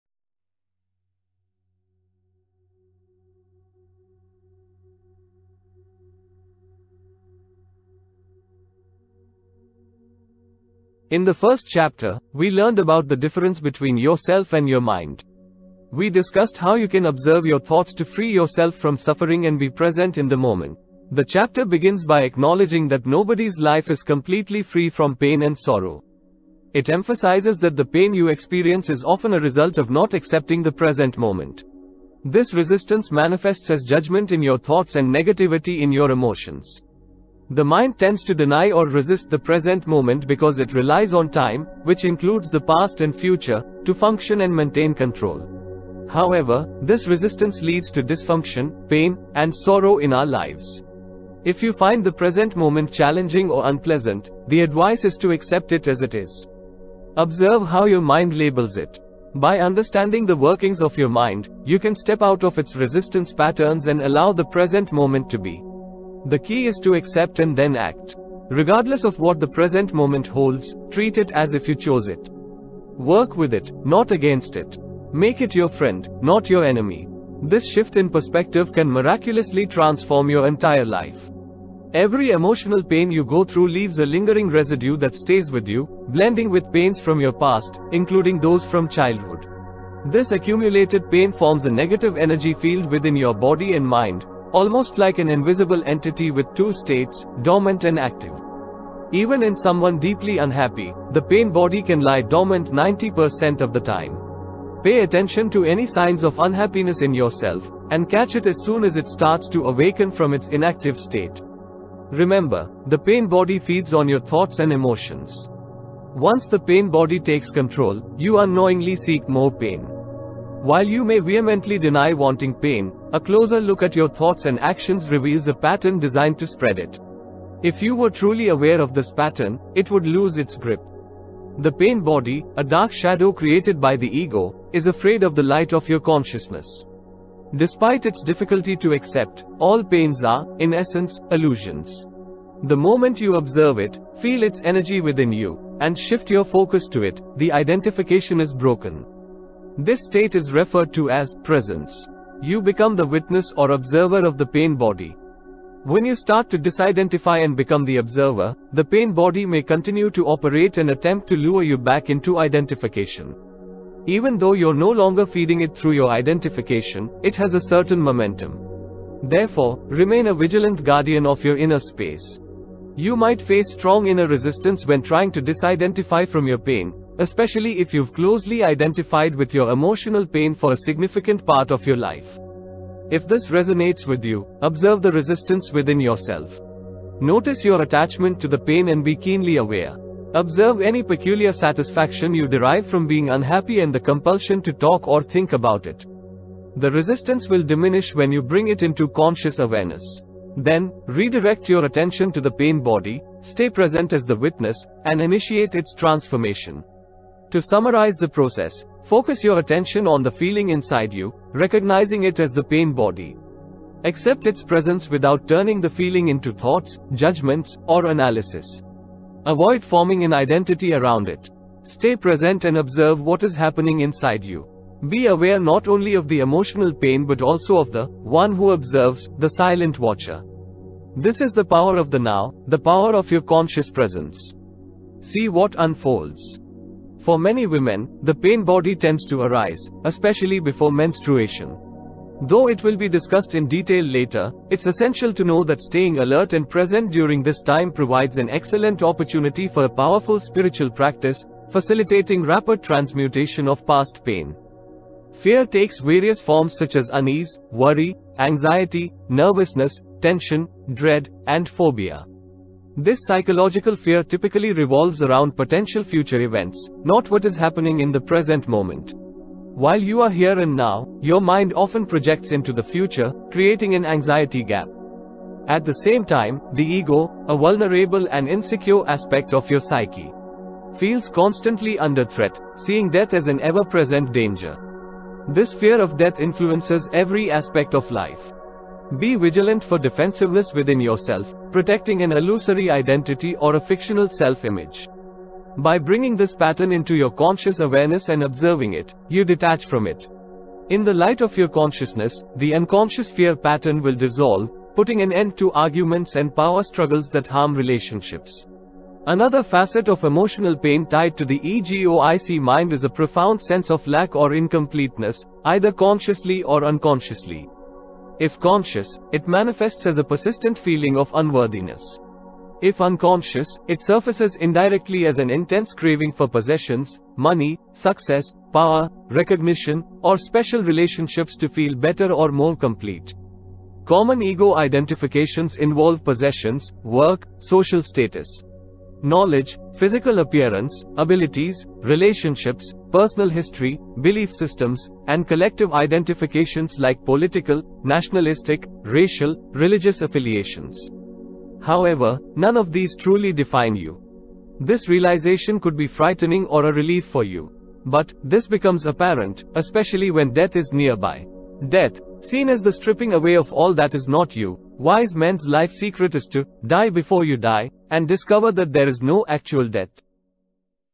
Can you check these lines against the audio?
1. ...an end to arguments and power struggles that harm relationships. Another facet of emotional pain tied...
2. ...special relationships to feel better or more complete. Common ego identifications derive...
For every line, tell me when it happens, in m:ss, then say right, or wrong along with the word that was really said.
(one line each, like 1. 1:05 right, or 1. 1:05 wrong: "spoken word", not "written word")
1. 5:05 right
2. 5:30 wrong: "involve", not "derive".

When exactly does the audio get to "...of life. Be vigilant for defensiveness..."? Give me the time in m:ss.
4:47.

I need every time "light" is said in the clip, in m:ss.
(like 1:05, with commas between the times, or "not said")
2:15, 5:01.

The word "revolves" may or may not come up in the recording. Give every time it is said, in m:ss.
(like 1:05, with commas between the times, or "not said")
4:24.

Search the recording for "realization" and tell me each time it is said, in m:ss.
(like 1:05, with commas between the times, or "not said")
5:55.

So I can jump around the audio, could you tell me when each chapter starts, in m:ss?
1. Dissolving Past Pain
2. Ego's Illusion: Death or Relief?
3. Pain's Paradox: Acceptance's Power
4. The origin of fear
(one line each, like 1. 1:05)
1. 1:21
2. 5:09
3. 0:21
4. 4:15.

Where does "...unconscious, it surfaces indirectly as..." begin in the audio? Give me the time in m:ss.
5:22.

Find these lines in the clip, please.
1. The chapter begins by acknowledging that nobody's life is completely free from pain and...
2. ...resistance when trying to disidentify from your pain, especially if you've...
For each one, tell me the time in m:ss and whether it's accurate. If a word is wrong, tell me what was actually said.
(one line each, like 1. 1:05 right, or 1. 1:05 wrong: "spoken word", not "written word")
1. 0:21 right
2. 2:54 right.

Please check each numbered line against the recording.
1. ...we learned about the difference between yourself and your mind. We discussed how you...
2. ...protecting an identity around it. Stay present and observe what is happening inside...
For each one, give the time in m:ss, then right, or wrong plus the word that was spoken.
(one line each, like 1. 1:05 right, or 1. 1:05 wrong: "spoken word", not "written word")
1. 0:12 right
2. 3:39 wrong: "forming", not "protecting".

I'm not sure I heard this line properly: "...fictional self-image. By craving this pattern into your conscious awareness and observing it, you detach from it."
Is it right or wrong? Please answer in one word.
wrong.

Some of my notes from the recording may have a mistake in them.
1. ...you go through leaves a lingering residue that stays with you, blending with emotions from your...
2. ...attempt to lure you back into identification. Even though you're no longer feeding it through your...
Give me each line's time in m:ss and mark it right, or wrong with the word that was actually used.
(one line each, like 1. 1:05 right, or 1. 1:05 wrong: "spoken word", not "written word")
1. 1:23 wrong: "pains", not "emotions"
2. 2:40 right.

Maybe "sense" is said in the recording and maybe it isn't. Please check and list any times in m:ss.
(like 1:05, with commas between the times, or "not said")
5:13.